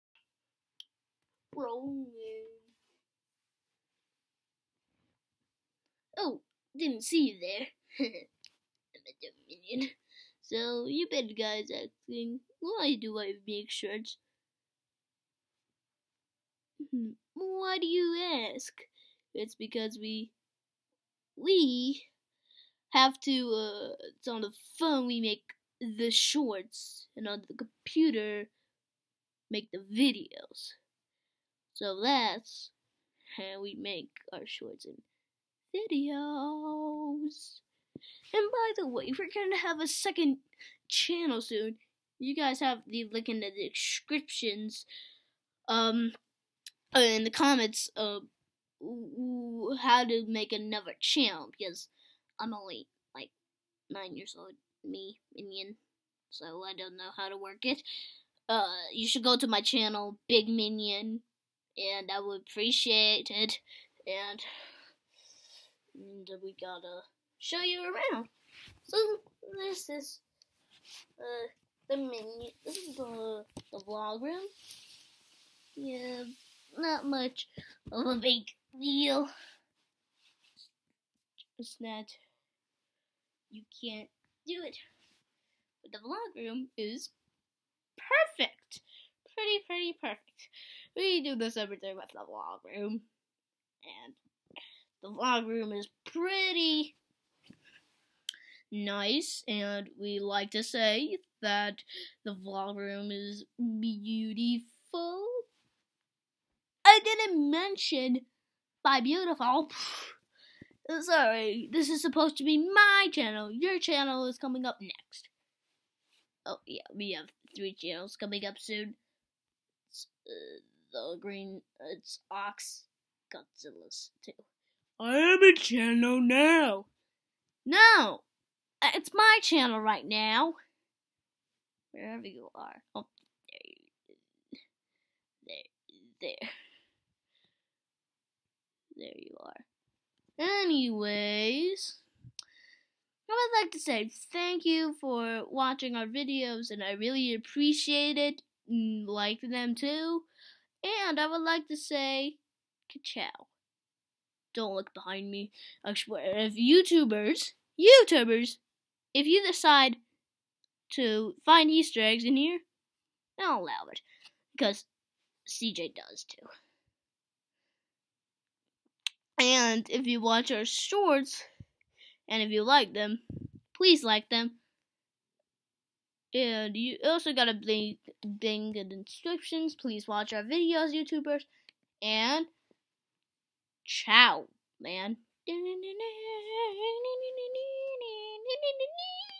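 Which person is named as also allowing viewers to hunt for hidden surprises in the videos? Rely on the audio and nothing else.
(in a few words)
CJ.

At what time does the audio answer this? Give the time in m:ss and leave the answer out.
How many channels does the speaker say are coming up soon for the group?
1:57.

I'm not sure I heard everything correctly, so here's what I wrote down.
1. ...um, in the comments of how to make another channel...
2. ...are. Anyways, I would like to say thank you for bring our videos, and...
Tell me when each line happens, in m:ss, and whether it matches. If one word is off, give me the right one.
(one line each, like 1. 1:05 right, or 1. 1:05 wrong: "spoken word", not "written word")
1. 0:45 right
2. 2:19 wrong: "watching", not "bring".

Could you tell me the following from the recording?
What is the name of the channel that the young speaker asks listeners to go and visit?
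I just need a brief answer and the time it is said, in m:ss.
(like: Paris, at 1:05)
Big Minion, at 1:00.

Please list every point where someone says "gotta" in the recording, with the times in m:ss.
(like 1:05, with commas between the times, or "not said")
1:06, 2:57.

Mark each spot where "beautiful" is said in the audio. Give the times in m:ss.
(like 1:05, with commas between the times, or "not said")
1:43, 1:49.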